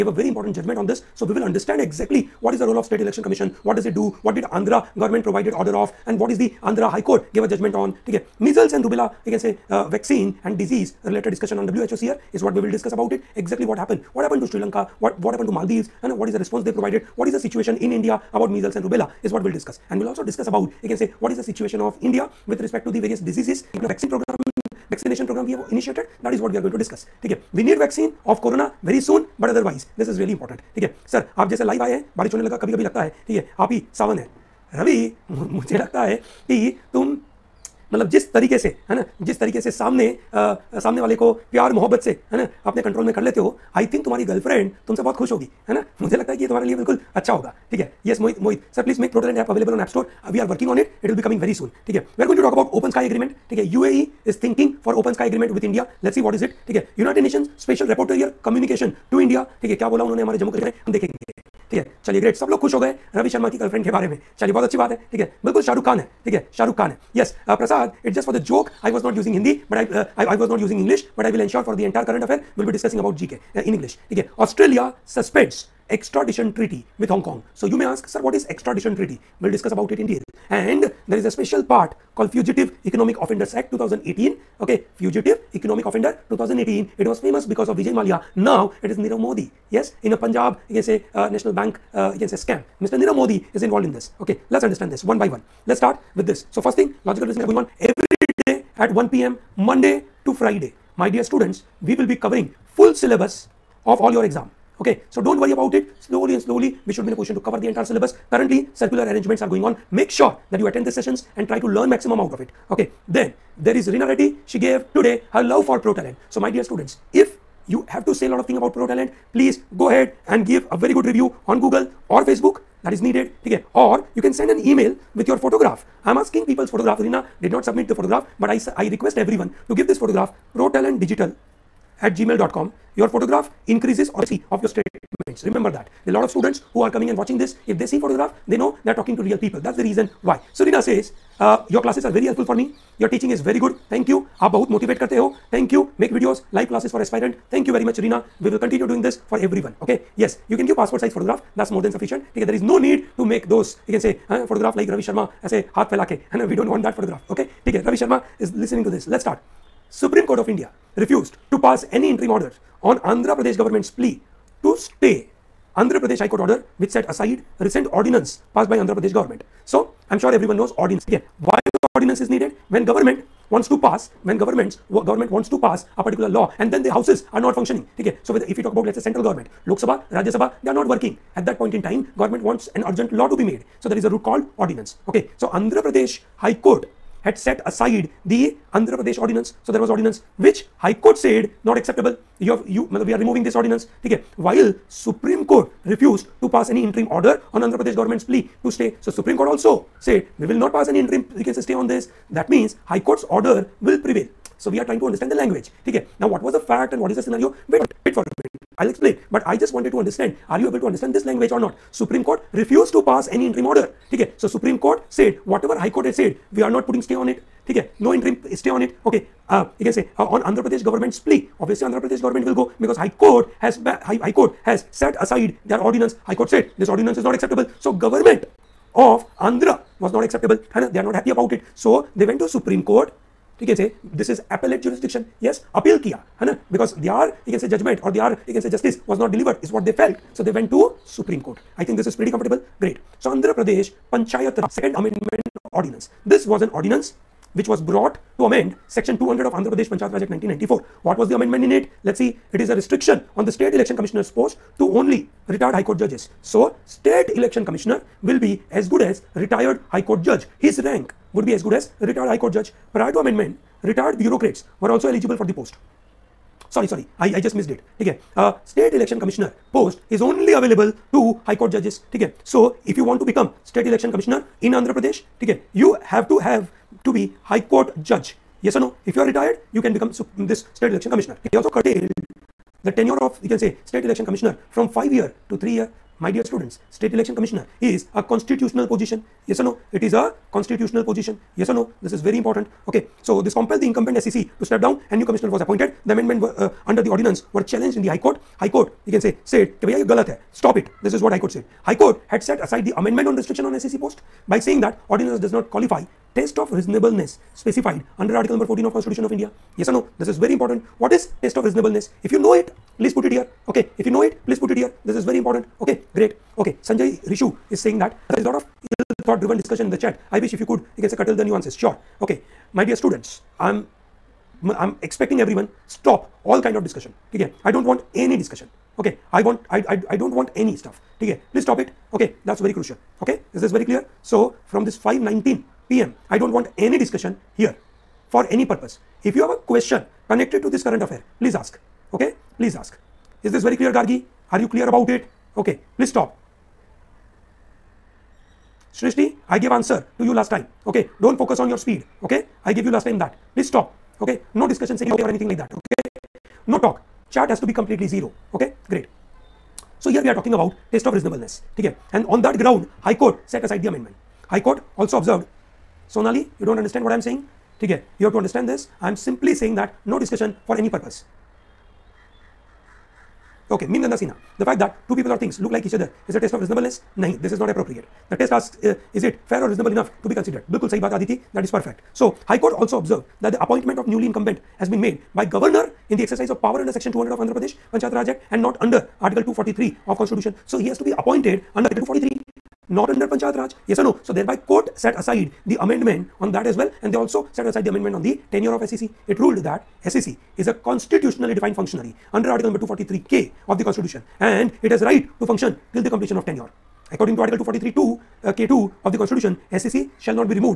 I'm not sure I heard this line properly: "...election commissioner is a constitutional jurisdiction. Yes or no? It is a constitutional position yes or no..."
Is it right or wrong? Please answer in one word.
wrong.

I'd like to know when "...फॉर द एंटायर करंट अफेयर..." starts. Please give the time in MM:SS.
01:11.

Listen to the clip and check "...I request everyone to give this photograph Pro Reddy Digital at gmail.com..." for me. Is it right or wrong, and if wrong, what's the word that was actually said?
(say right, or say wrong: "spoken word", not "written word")
wrong: "Talent", not "Reddy".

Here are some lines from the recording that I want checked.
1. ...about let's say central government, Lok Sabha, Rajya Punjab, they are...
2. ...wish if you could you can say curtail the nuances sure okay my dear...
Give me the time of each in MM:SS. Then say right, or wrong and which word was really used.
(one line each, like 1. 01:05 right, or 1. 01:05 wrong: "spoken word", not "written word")
1. 02:58 wrong: "Sabha", not "Punjab"
2. 05:20 right.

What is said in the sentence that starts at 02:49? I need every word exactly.
So, I am sure everyone knows ordinance.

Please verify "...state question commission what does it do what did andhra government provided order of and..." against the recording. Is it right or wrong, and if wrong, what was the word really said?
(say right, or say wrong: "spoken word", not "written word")
wrong: "election", not "question".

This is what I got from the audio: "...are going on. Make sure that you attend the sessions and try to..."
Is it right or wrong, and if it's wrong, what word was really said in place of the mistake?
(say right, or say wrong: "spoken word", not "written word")
right.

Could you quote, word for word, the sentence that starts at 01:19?
We'll discuss about it in detail.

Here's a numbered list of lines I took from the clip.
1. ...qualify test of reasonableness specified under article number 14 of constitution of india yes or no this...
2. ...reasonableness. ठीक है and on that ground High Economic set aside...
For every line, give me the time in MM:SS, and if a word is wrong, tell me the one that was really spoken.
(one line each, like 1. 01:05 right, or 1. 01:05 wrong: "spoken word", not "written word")
1. 05:05 right
2. 06:01 wrong: "Court", not "Economic".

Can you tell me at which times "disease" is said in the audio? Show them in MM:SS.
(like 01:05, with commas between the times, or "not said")
00:10, 00:23.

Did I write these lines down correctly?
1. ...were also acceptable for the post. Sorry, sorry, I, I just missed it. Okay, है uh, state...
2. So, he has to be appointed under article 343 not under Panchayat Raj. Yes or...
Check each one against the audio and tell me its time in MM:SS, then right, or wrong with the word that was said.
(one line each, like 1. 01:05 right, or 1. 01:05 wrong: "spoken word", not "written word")
1. 04:24 wrong: "eligible", not "acceptable"
2. 06:30 wrong: "243", not "343".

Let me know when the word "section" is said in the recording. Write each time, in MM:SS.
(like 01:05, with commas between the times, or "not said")
04:08, 06:26.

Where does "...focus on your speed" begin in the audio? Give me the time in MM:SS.
05:51.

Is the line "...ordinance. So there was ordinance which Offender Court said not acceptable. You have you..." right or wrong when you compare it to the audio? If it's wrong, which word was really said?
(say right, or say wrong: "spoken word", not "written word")
wrong: "High", not "Offender".